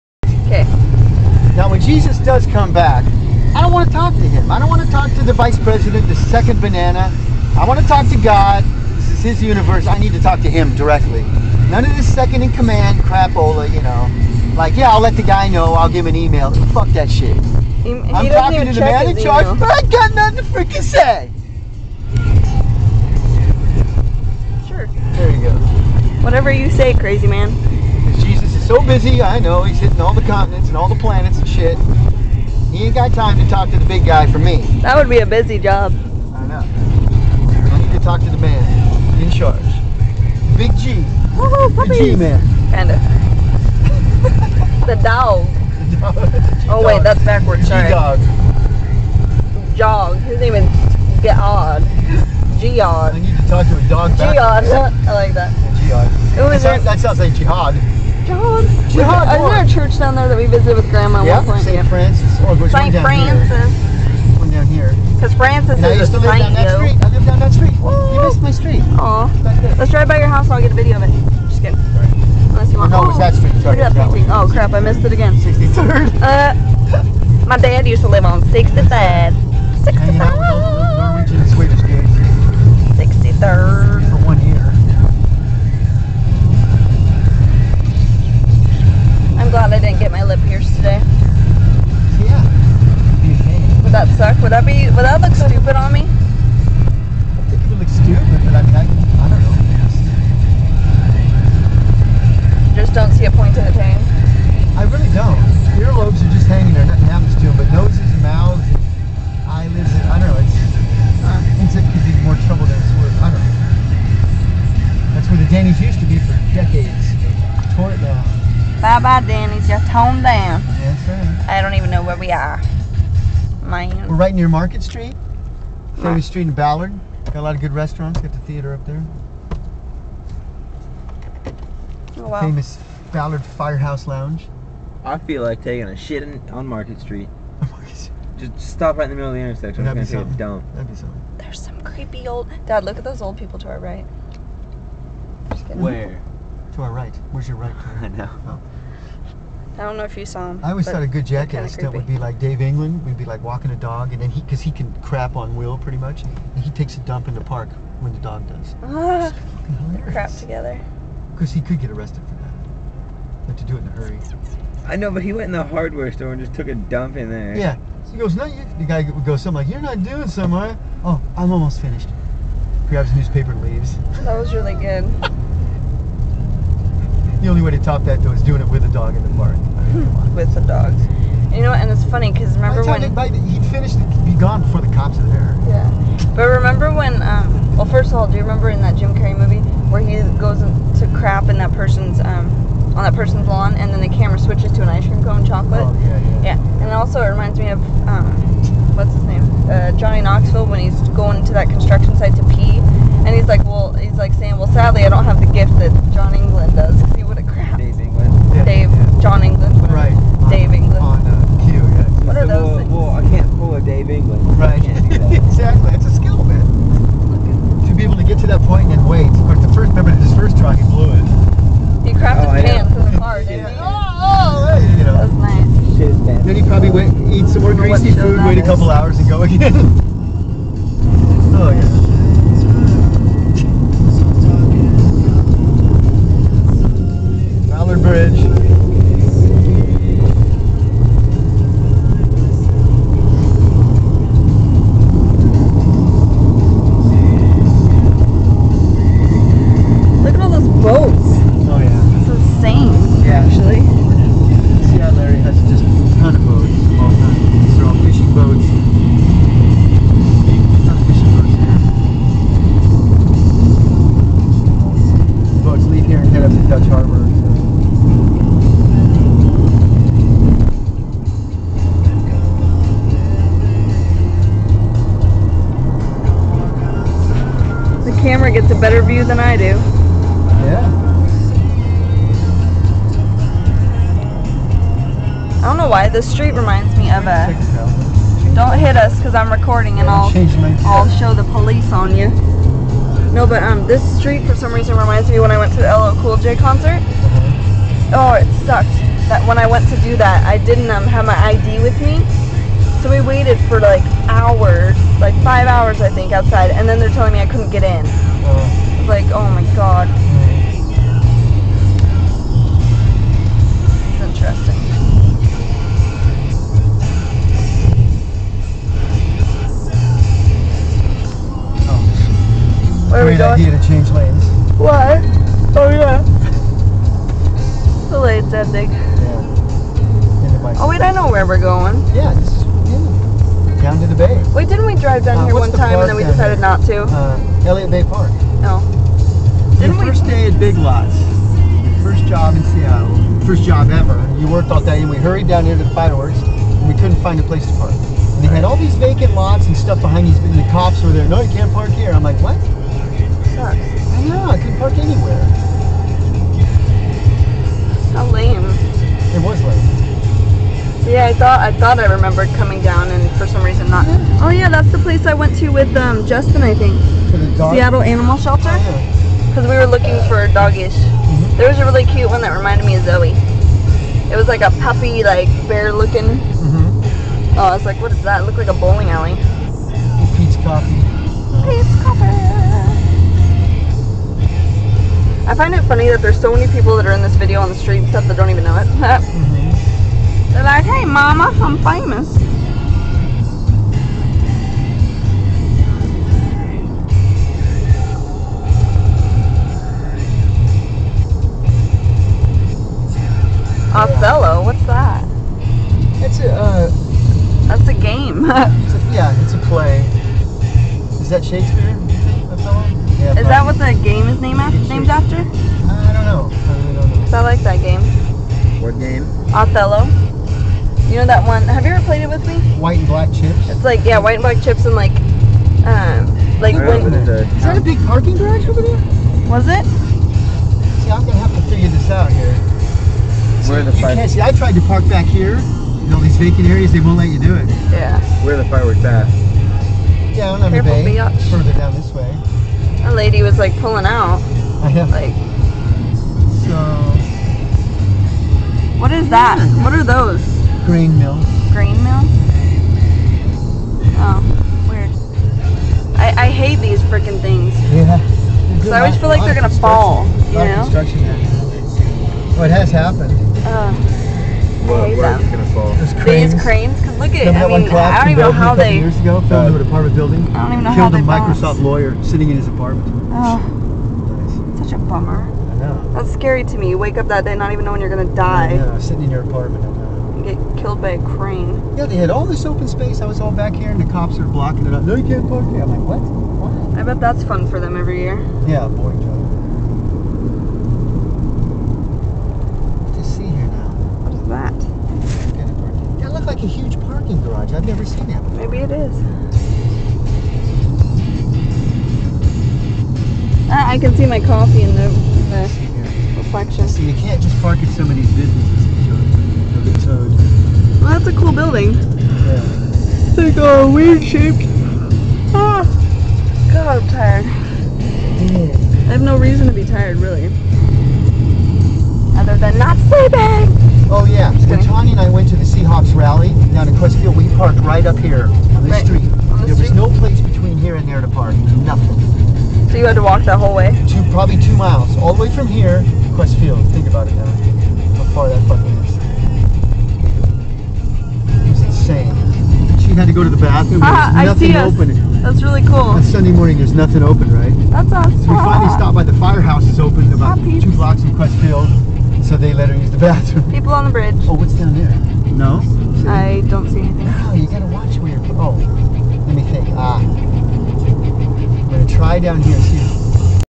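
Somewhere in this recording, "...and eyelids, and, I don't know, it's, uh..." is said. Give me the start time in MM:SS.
01:48.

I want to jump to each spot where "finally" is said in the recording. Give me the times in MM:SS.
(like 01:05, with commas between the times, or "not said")
09:08.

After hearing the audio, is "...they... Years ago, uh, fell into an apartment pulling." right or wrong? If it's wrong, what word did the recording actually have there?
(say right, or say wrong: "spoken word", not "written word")
wrong: "building", not "pulling".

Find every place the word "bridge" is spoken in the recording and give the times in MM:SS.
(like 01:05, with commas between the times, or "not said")
03:57, 09:14.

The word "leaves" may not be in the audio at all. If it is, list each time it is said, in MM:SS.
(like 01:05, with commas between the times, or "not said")
02:53.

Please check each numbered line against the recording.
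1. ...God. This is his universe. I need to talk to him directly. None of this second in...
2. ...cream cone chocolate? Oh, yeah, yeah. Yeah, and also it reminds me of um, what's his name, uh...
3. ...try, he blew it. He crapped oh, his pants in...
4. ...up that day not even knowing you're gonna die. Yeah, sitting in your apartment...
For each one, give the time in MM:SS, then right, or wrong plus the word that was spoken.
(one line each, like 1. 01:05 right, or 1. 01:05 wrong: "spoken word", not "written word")
1. 00:08 right
2. 03:15 right
3. 03:40 right
4. 07:57 right.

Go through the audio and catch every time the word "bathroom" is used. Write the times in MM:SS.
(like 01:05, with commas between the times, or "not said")
09:03, 09:13.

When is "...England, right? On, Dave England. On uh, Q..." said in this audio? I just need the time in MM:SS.
03:29.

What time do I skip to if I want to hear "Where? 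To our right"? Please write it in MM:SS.
02:25.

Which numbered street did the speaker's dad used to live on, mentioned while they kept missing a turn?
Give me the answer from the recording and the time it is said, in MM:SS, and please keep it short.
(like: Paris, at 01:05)
63rd, at 01:17.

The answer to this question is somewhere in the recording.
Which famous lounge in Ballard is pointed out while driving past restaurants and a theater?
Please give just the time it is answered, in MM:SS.
02:12.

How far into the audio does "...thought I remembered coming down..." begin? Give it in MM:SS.
06:01.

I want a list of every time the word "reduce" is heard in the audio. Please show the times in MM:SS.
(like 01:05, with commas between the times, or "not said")
not said.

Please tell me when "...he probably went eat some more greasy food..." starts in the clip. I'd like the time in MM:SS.
03:46.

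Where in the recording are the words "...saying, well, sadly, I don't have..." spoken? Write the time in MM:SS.
03:24.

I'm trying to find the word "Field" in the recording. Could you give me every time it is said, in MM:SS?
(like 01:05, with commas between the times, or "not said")
08:47, 08:56, 09:11.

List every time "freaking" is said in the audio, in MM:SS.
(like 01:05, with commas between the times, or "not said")
00:20, 07:37.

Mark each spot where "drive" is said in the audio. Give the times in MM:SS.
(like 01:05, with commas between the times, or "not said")
01:09, 05:34.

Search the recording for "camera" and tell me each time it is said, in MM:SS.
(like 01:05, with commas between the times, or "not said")
03:14, 04:38.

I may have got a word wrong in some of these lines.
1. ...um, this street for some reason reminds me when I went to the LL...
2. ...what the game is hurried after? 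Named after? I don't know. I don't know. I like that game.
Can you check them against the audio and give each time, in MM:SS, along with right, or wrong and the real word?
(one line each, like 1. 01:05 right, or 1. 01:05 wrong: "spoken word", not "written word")
1. 04:53 right
2. 06:53 wrong: "named", not "hurried".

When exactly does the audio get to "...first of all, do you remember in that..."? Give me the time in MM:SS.
03:07.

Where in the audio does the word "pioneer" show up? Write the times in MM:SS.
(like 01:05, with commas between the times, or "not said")
not said.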